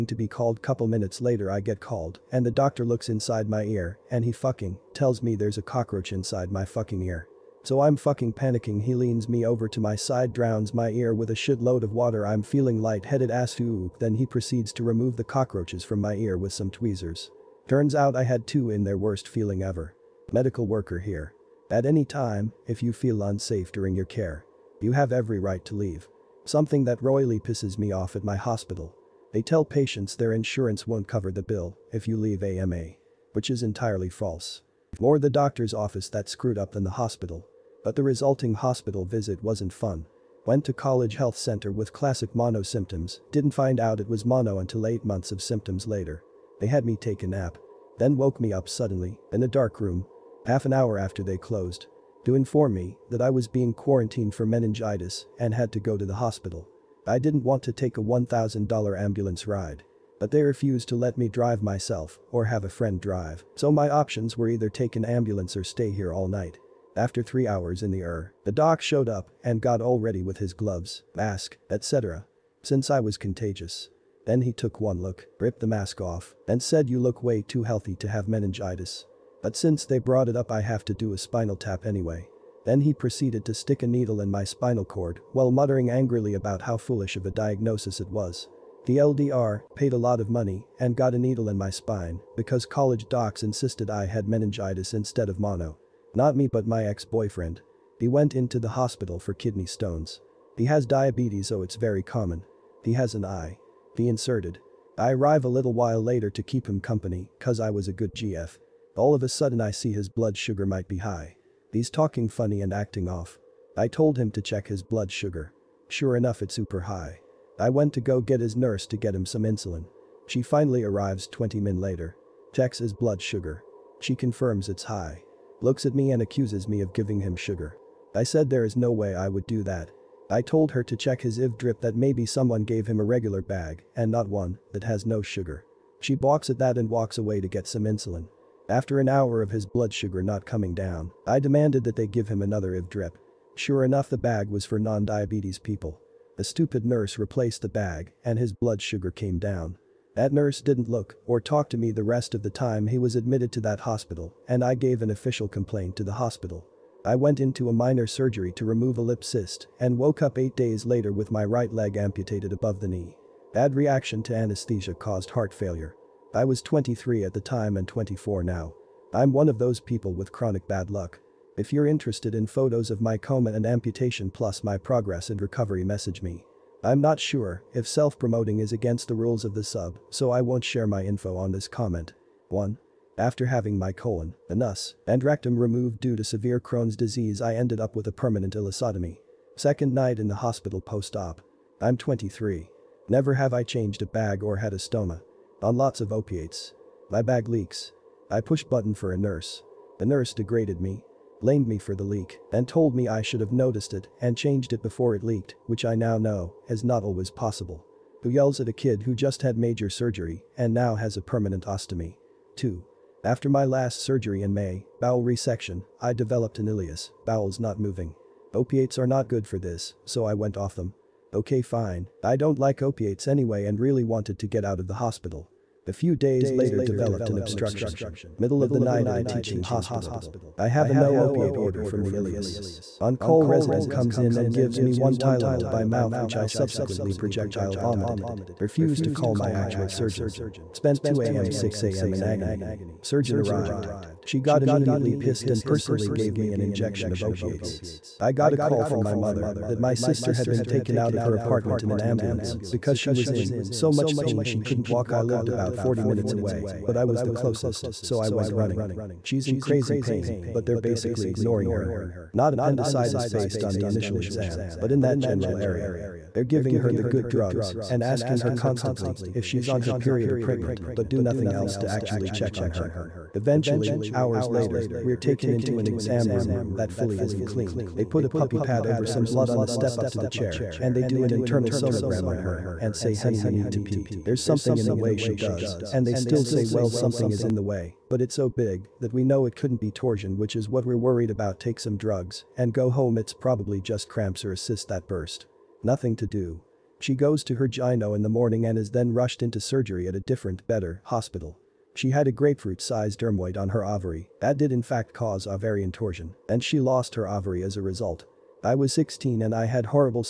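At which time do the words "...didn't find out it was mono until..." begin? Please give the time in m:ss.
0:43.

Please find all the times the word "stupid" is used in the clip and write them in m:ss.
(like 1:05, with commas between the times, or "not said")
2:26.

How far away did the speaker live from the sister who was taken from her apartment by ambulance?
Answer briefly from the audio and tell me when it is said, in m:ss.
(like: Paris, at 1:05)
40 minutes, at 4:15.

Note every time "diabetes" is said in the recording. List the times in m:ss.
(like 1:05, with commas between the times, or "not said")
1:40, 2:24.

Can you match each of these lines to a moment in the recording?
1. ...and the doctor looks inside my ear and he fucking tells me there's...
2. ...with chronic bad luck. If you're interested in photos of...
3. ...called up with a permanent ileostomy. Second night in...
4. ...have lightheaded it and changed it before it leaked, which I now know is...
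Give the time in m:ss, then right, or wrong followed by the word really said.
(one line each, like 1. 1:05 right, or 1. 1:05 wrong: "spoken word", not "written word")
1. 0:02 right
2. 2:50 right
3. 3:07 wrong: "ended", not "called"
4. 3:23 wrong: "noticed", not "lightheaded".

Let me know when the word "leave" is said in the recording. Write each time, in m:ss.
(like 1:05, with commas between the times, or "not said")
0:25, 0:32.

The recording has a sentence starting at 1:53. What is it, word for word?
I told him to check his blood sugar.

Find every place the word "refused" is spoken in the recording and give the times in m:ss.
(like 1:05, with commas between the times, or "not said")
1:00, 3:58.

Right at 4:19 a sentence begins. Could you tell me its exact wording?
She's in crazy pain, but they're basically ignoring her.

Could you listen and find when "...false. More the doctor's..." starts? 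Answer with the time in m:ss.
0:34.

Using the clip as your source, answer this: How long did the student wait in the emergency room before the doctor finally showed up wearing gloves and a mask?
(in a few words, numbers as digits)
3 hours.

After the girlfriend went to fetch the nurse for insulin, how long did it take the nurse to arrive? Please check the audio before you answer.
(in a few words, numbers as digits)
20 minutes.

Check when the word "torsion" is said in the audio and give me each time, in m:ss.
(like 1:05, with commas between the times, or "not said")
4:49, 5:05.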